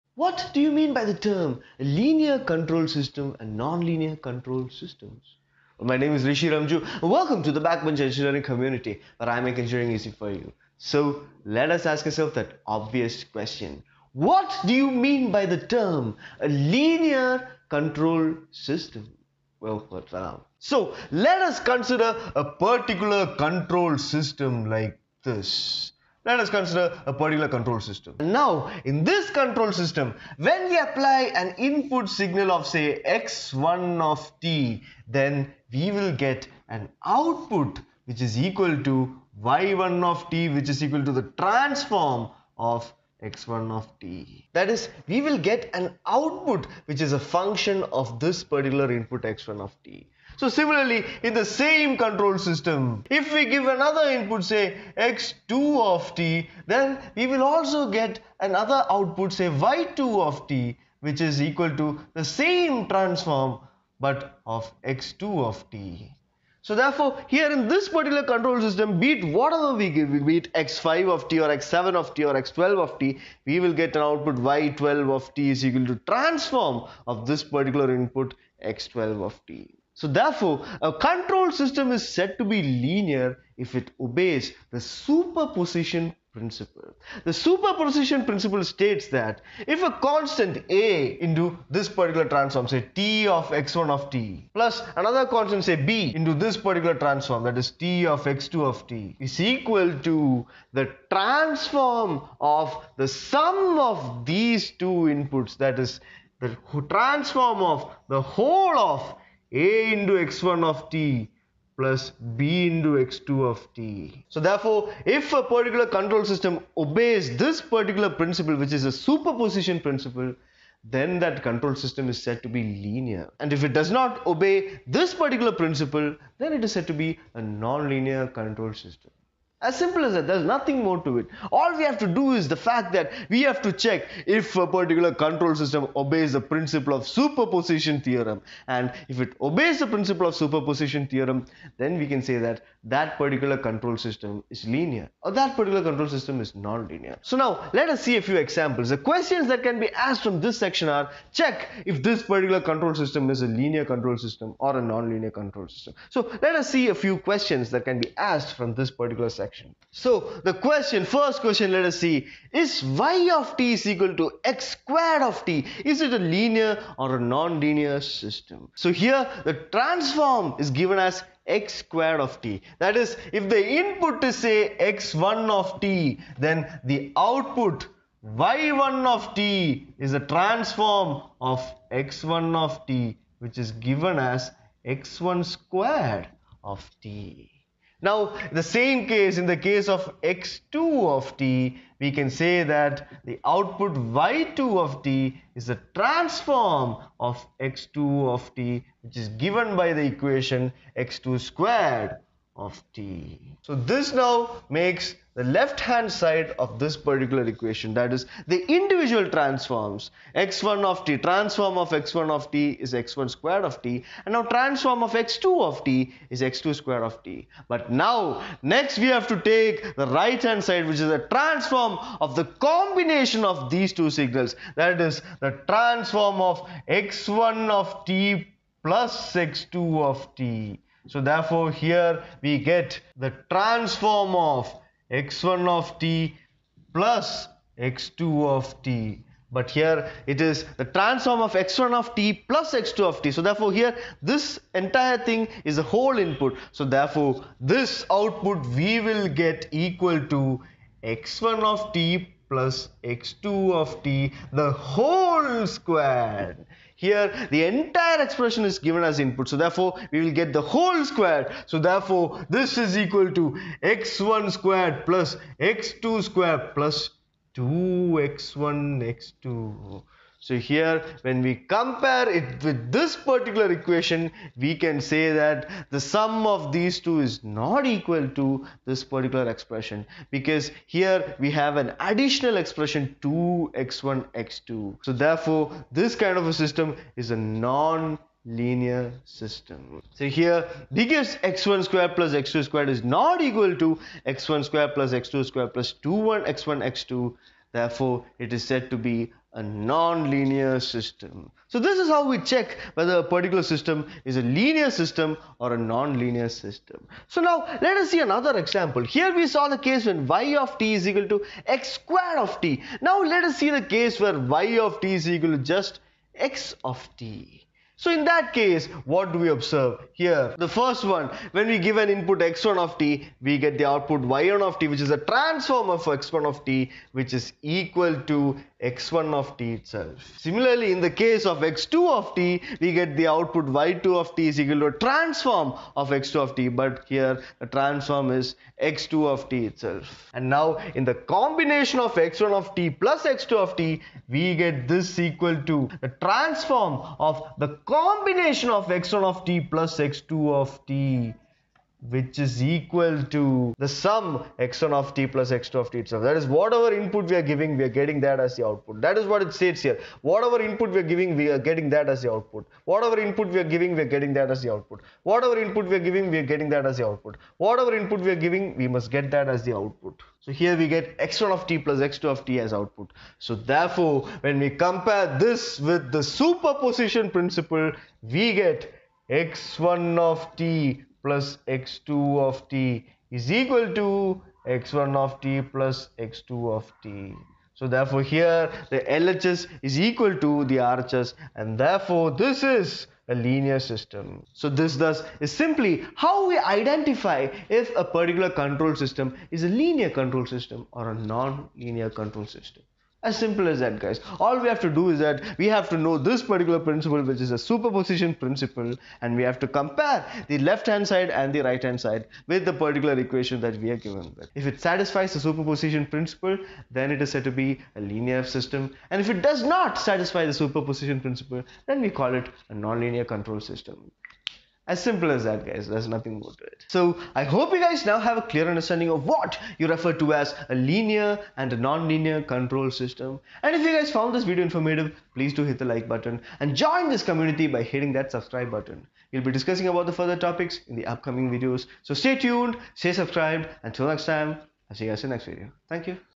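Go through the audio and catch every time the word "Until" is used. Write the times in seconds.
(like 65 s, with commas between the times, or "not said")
443 s.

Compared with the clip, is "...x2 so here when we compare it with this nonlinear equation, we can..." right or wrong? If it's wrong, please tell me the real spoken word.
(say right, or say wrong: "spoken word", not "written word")
wrong: "particular", not "nonlinear".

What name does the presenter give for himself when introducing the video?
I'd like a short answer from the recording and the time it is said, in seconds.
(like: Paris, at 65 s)
Rishi Remju, at 6 s.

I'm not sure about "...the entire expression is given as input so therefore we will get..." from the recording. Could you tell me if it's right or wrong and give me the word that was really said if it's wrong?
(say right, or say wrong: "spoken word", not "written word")
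right.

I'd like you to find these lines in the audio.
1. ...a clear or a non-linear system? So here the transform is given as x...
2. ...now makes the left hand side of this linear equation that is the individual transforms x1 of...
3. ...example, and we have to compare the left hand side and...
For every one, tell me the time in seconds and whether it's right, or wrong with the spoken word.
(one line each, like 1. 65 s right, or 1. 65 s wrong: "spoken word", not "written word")
1. 166 s wrong: "linear", not "clear"
2. 204 s wrong: "particular", not "linear"
3. 408 s wrong: "principle", not "example".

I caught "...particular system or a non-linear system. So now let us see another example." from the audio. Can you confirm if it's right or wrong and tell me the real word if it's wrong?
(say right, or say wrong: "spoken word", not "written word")
wrong: "linear", not "particular".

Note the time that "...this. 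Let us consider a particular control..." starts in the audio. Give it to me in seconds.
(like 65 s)
25 s.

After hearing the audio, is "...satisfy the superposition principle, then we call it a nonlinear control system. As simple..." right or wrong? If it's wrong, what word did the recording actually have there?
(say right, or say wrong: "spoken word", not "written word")
right.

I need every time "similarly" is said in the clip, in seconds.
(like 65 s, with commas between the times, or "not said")
50 s, 330 s.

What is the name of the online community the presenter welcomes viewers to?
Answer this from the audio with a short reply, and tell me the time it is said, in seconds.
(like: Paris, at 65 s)
Backbench Engineering, at 7 s.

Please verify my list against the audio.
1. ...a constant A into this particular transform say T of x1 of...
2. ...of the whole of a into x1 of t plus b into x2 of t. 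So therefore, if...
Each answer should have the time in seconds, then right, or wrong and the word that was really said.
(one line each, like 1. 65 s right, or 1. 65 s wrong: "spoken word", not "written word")
1. 89 s right
2. 107 s right.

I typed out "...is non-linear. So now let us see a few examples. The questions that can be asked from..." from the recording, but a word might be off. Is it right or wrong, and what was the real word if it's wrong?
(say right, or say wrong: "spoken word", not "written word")
right.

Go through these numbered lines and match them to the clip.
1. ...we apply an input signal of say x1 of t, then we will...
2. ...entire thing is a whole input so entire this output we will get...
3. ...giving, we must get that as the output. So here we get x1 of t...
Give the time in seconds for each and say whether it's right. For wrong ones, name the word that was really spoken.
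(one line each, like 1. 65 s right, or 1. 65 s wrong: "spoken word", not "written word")
1. 30 s right
2. 244 s wrong: "therefore", not "entire"
3. 368 s right.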